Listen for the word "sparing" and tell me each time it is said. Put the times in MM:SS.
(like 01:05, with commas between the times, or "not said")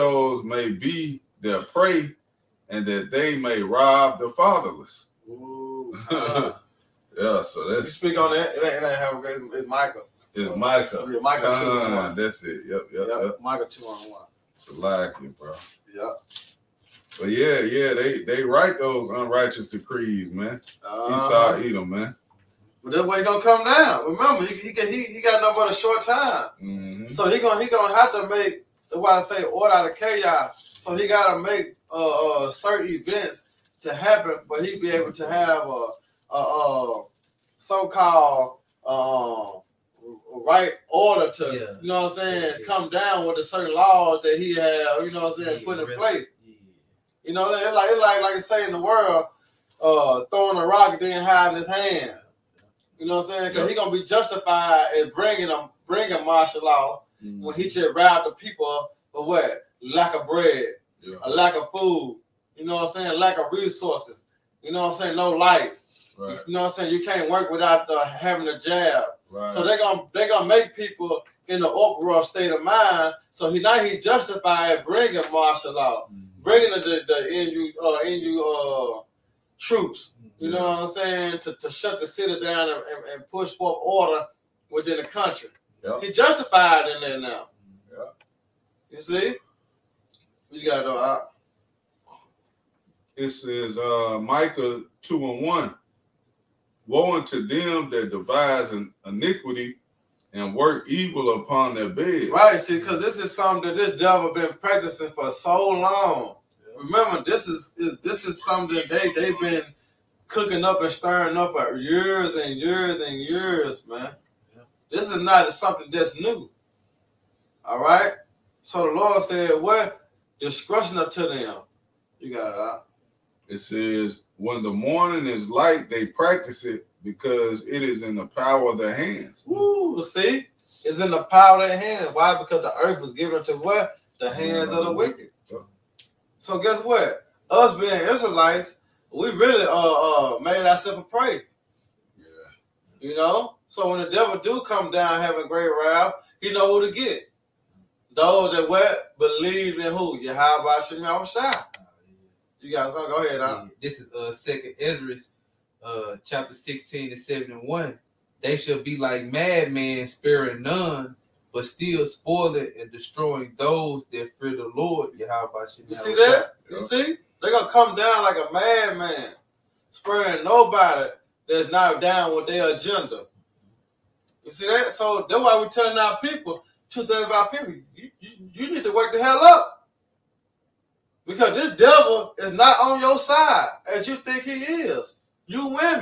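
02:40, 02:49.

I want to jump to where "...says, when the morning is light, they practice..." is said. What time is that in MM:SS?
02:03.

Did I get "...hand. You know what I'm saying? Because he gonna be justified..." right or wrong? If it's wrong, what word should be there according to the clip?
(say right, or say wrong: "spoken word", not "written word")
right.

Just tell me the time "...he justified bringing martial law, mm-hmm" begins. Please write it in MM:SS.
01:13.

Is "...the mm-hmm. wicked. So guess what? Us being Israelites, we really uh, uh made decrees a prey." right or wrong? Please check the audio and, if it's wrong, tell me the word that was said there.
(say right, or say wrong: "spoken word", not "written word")
wrong: "ourselves", not "decrees".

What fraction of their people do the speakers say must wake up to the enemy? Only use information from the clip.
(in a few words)
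2/3.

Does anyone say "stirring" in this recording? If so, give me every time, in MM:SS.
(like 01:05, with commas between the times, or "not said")
01:50.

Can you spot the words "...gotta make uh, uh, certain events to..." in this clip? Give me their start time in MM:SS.
00:31.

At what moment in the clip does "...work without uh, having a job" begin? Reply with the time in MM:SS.
01:07.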